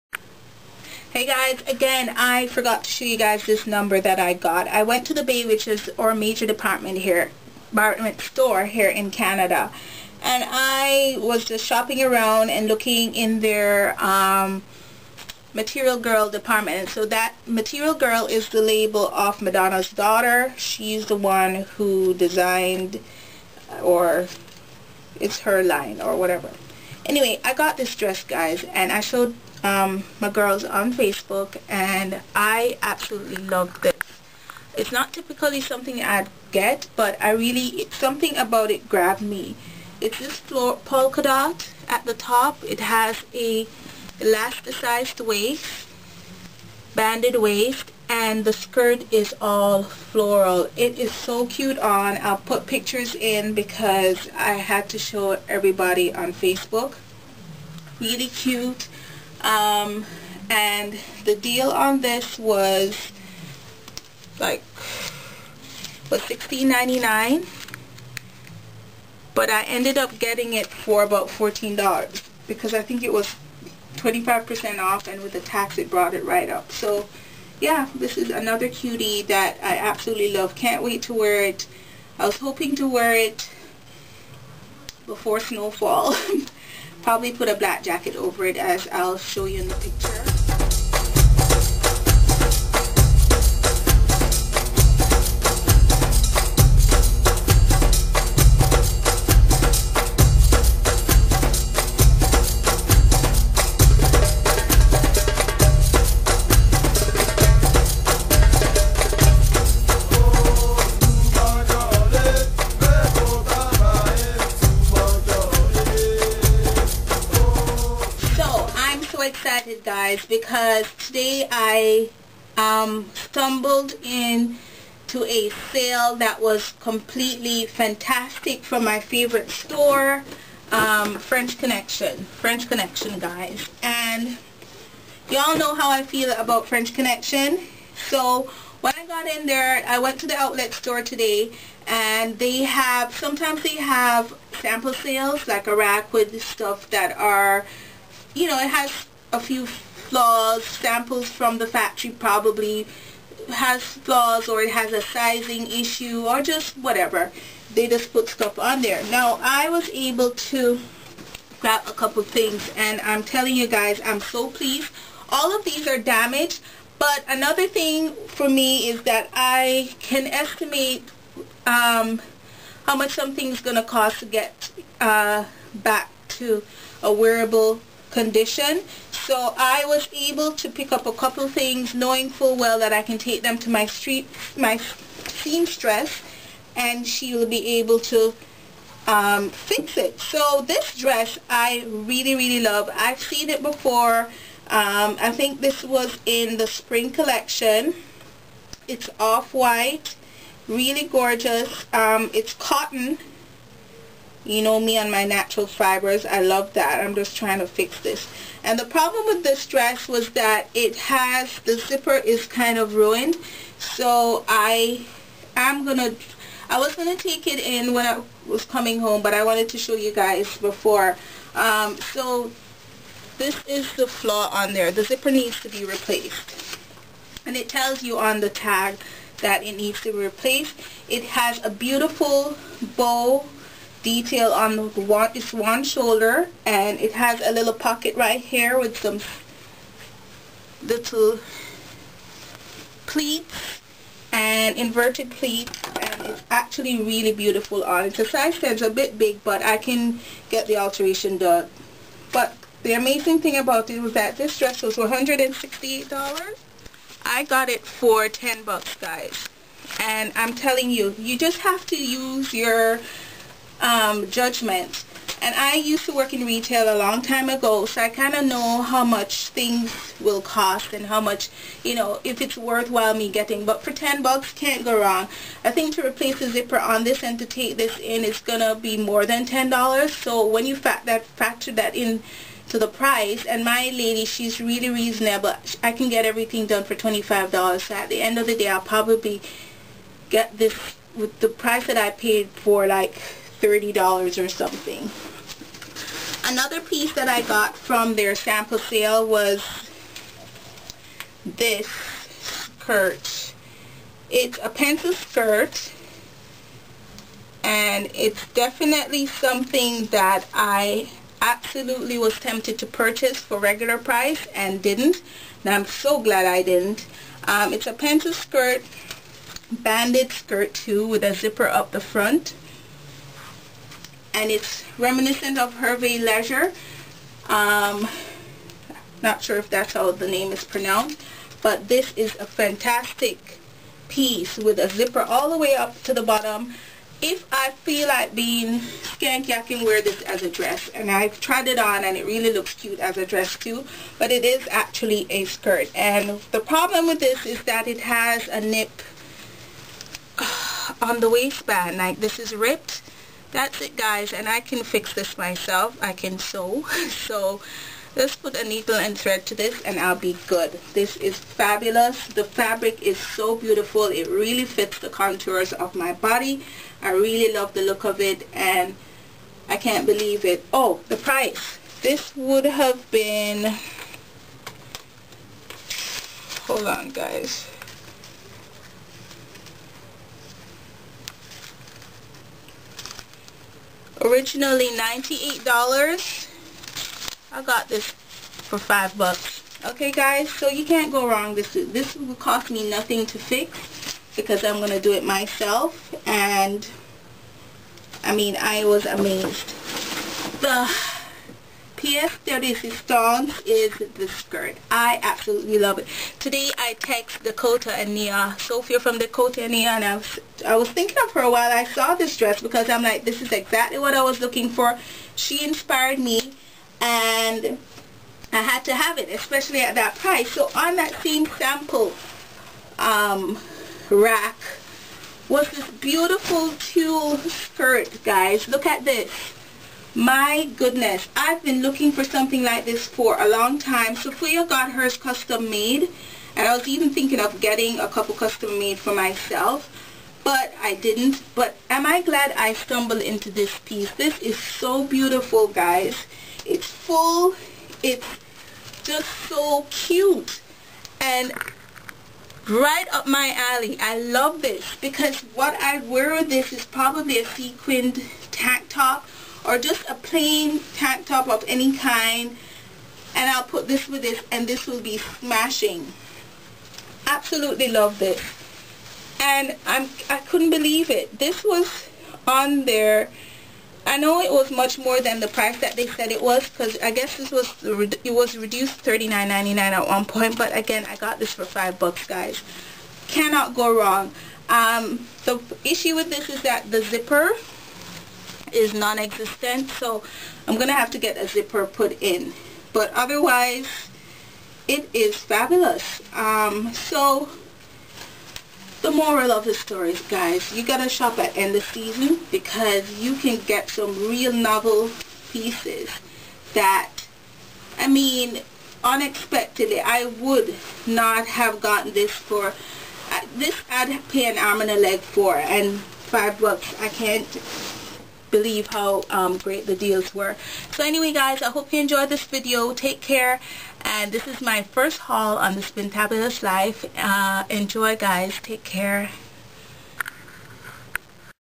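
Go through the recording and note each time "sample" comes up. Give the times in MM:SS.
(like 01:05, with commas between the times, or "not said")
02:24, 02:30, 04:58, 07:01.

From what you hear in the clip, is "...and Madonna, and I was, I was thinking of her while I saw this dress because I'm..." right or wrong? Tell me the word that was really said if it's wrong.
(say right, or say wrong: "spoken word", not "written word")
wrong: "Neah", not "Madonna".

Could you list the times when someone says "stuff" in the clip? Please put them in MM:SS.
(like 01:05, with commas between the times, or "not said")
02:26, 02:38.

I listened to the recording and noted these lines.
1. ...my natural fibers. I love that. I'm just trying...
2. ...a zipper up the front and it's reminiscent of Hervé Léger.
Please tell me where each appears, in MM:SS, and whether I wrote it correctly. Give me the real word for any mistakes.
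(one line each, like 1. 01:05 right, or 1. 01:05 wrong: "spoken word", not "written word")
1. 03:25 right
2. 05:21 right.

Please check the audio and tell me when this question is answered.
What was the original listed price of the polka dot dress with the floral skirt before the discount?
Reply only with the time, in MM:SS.
01:06.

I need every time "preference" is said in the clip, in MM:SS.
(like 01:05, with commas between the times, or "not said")
not said.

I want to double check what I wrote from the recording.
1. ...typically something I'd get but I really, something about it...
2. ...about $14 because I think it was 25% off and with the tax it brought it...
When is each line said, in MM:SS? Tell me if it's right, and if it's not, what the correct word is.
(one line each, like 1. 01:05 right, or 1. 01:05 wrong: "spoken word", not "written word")
1. 00:35 right
2. 01:11 right.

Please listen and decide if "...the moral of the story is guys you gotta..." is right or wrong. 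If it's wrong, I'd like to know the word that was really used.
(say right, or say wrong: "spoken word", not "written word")
right.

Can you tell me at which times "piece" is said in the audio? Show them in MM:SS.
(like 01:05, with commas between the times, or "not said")
04:56, 05:34, 07:23, 08:25.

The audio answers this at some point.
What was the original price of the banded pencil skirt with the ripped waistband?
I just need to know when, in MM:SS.
06:24.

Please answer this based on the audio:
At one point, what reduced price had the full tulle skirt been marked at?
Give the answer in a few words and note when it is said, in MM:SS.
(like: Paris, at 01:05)
$39.99, at 07:59.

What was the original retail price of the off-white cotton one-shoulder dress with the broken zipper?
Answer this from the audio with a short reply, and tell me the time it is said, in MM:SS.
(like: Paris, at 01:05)
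$168, at 04:14.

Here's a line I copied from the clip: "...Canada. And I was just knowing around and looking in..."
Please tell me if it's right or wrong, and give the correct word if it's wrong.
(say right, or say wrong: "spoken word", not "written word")
wrong: "shopping", not "knowing".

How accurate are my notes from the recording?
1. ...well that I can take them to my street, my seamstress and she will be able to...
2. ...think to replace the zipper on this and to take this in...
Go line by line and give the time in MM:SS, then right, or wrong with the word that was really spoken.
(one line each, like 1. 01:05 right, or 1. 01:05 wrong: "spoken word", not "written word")
1. 03:02 right
2. 04:35 right.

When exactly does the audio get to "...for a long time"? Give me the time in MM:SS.
07:13.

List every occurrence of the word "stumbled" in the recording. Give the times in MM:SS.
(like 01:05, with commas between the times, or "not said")
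02:03, 07:22.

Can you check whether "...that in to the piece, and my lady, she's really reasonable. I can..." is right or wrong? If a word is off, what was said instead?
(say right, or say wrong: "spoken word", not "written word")
wrong: "price", not "piece".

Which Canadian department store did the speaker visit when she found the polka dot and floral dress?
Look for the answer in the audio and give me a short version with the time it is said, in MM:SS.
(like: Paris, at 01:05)
The Bay, at 00:05.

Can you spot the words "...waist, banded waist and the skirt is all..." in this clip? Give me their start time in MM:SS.
00:45.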